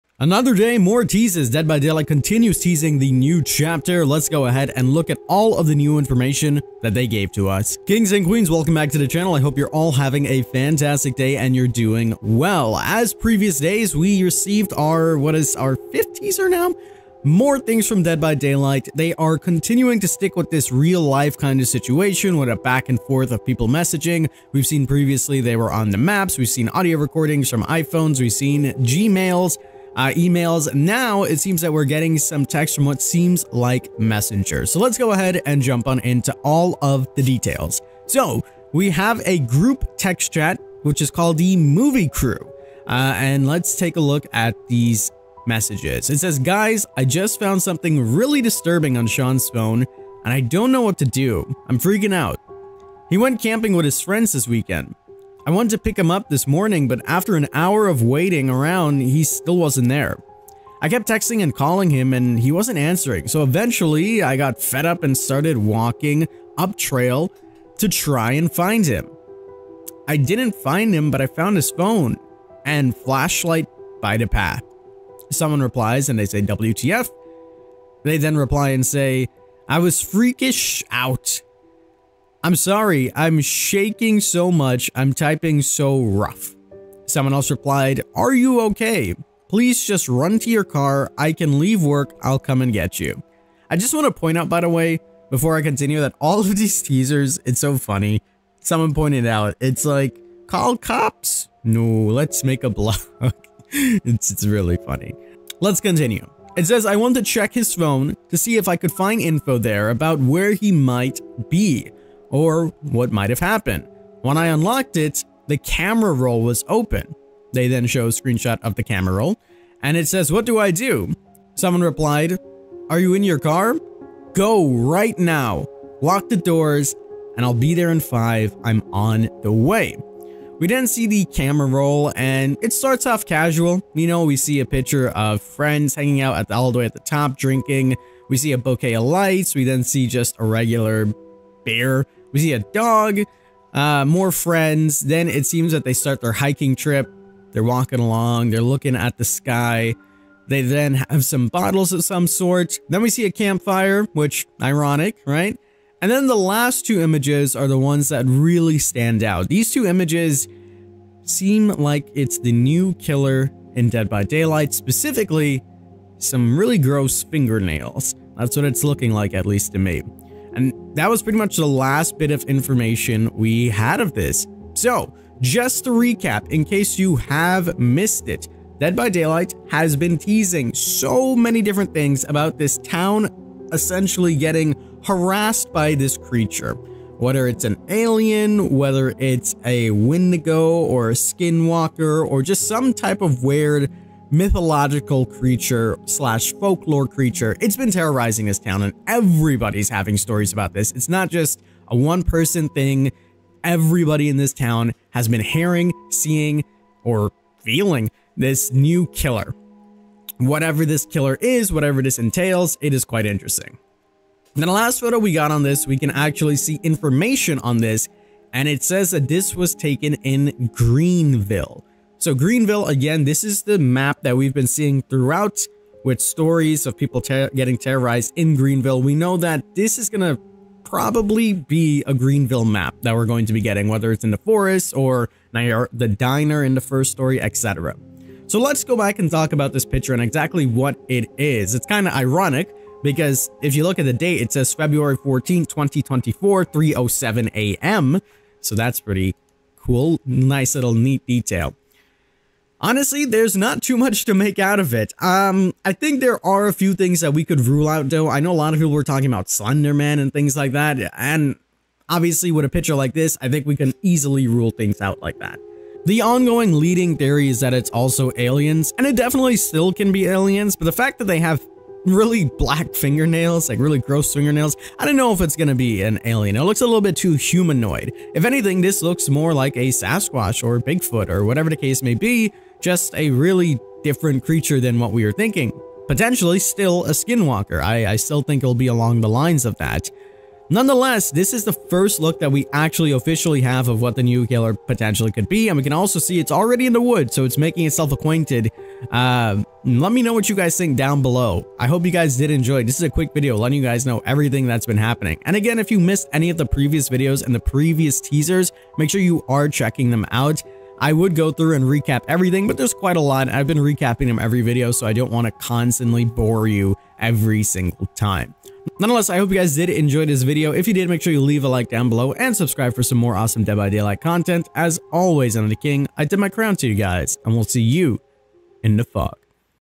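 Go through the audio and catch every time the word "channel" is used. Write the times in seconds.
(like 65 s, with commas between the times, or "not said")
9 s.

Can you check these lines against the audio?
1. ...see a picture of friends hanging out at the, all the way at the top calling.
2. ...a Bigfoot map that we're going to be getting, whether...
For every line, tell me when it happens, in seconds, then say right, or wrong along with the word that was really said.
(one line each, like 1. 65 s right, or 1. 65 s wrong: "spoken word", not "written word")
1. 134 s wrong: "drinking", not "calling"
2. 232 s wrong: "Greenville", not "Bigfoot".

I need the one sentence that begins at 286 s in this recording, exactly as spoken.
Potentially still a skinwalker, I, I still think it'll be along the lines of that.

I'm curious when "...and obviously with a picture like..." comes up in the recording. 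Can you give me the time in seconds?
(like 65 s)
261 s.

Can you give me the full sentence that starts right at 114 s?
When I unlocked it, the camera roll was open.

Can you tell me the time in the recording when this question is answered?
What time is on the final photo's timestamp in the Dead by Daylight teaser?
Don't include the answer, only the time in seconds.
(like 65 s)
246 s.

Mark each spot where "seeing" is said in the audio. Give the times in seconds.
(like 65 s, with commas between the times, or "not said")
206 s, 224 s.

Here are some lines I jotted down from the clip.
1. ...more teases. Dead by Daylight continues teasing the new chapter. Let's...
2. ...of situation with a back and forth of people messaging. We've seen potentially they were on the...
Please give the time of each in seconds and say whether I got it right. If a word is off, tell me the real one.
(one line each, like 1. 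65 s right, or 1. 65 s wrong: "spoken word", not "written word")
1. 0 s right
2. 21 s wrong: "previously", not "potentially".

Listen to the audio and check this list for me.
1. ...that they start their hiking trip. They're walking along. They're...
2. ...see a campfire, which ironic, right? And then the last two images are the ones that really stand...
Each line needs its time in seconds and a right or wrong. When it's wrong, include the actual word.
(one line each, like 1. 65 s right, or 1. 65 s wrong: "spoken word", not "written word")
1. 145 s right
2. 153 s right.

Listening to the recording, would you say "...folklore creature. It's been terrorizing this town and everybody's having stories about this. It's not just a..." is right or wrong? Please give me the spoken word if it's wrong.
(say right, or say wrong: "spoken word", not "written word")
right.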